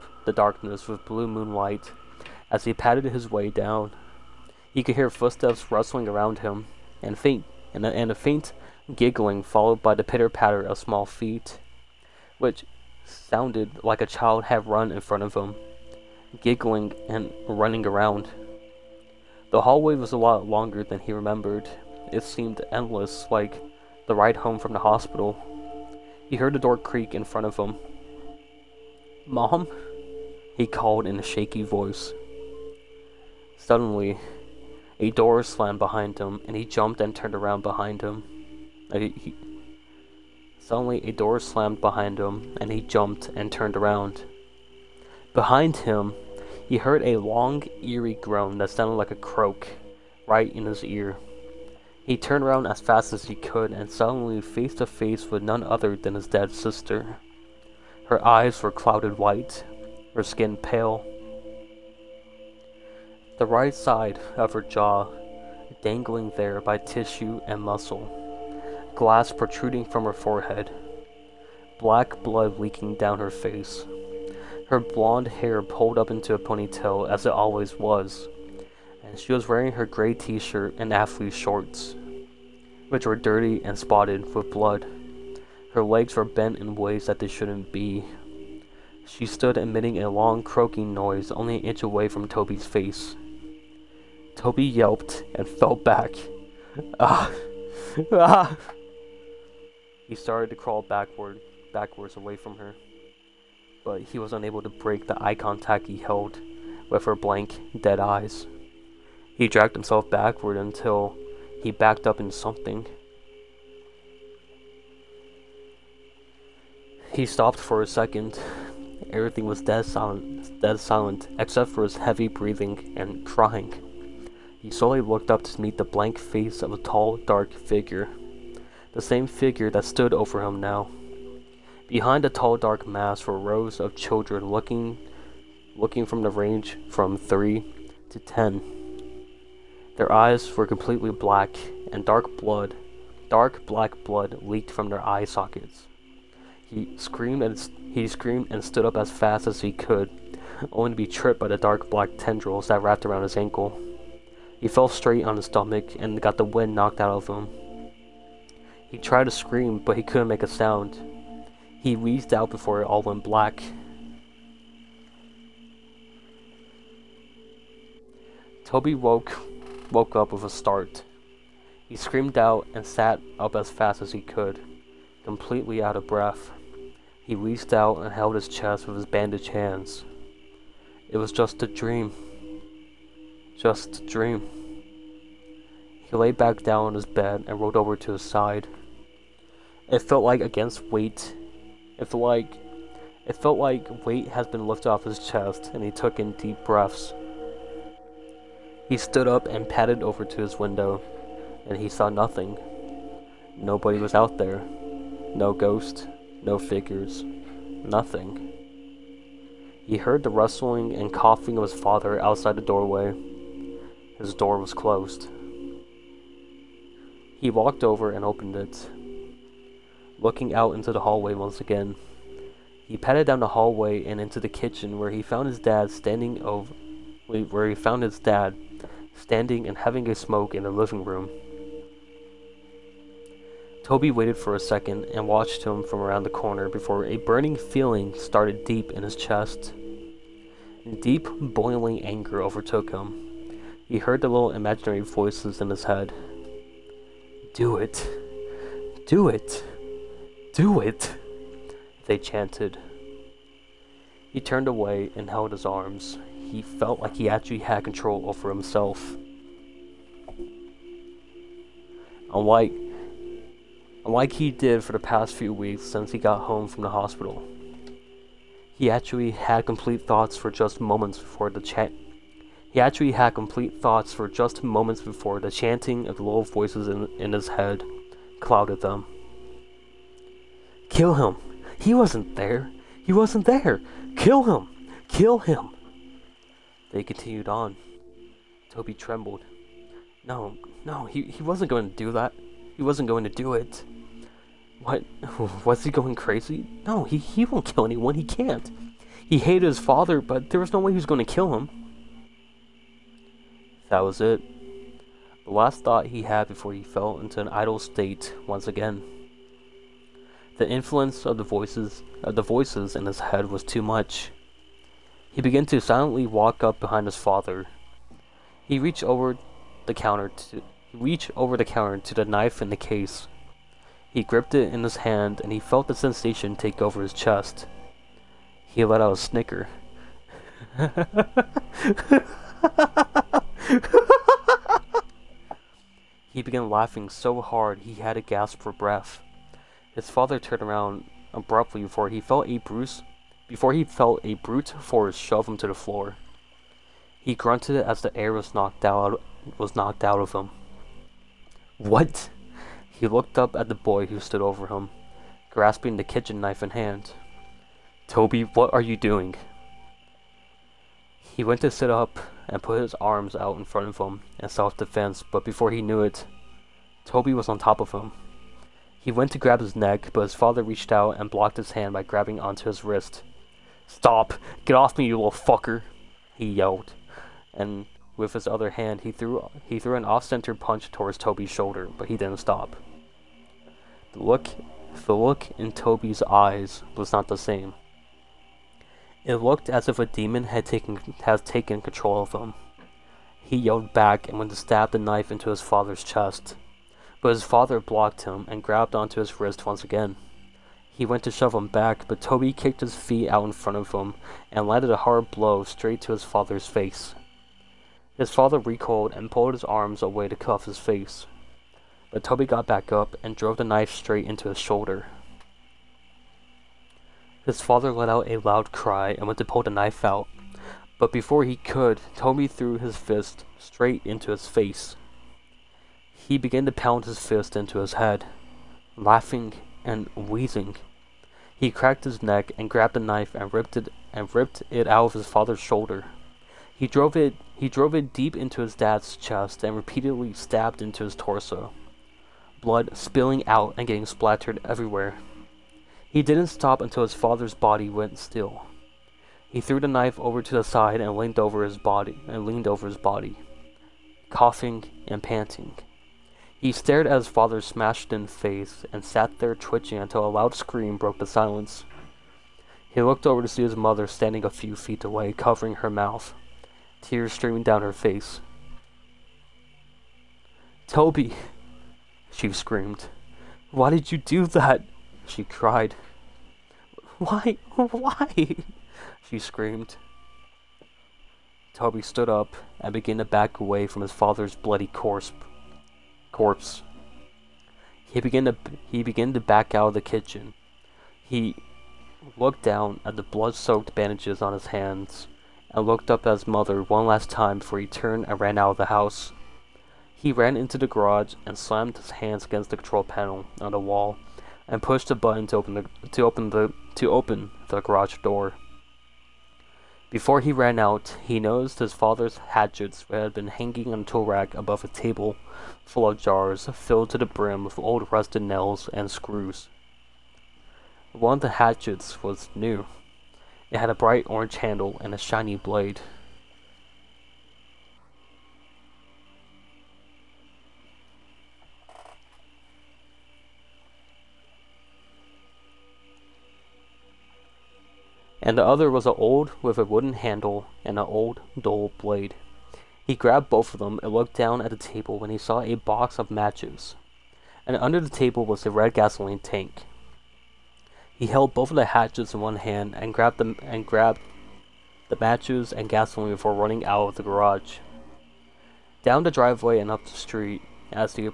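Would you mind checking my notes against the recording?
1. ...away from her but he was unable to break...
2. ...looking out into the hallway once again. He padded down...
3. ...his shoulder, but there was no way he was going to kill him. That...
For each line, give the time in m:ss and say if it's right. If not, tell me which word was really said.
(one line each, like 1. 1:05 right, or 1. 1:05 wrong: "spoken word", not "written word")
1. 1:42 right
2. 3:40 right
3. 4:59 wrong: "father", not "shoulder".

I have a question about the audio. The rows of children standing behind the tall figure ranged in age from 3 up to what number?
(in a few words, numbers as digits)
10.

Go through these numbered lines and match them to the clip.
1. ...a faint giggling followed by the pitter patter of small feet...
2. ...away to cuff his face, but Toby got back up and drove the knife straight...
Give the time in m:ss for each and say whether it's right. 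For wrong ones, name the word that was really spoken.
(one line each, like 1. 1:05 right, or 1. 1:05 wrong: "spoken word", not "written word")
1. 0:08 right
2. 6:50 right.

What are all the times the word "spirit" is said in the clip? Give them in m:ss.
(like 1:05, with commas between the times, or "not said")
not said.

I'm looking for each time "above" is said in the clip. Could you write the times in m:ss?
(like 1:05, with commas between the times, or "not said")
8:34.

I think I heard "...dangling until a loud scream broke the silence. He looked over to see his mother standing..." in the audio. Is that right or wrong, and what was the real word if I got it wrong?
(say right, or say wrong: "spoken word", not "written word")
wrong: "twitching", not "dangling".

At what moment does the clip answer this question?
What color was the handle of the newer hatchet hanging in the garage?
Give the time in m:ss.
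8:44.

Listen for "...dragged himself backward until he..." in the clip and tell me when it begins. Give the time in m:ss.
1:49.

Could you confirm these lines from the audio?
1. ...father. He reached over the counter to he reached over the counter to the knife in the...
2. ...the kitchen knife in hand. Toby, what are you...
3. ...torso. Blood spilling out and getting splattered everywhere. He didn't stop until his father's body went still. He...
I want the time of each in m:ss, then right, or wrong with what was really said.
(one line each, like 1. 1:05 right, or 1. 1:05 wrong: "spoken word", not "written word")
1. 5:17 right
2. 5:55 right
3. 7:21 right.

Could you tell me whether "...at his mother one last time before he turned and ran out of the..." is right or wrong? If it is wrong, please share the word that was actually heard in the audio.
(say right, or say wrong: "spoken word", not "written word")
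right.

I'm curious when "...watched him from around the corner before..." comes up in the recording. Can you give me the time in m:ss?
3:55.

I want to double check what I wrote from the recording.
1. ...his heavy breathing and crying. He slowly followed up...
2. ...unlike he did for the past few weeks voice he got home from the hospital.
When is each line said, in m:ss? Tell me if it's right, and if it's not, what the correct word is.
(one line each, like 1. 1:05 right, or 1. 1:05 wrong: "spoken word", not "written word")
1. 2:01 wrong: "looked", not "followed"
2. 4:24 wrong: "since", not "voice".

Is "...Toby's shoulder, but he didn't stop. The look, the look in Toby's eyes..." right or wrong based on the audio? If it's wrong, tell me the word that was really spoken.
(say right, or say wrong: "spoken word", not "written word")
right.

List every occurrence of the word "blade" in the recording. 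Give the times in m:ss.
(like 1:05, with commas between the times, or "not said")
8:45, 9:01.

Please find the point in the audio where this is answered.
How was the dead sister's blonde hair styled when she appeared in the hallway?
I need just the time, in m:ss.
1:16.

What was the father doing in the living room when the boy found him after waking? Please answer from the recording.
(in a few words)
Having a smoke.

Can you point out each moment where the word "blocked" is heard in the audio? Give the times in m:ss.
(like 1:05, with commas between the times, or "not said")
6:11, 6:37.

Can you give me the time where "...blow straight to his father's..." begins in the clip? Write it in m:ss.
6:45.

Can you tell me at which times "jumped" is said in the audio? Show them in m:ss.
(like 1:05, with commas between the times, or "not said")
0:36, 0:42.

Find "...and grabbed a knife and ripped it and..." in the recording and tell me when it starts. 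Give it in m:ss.
7:12.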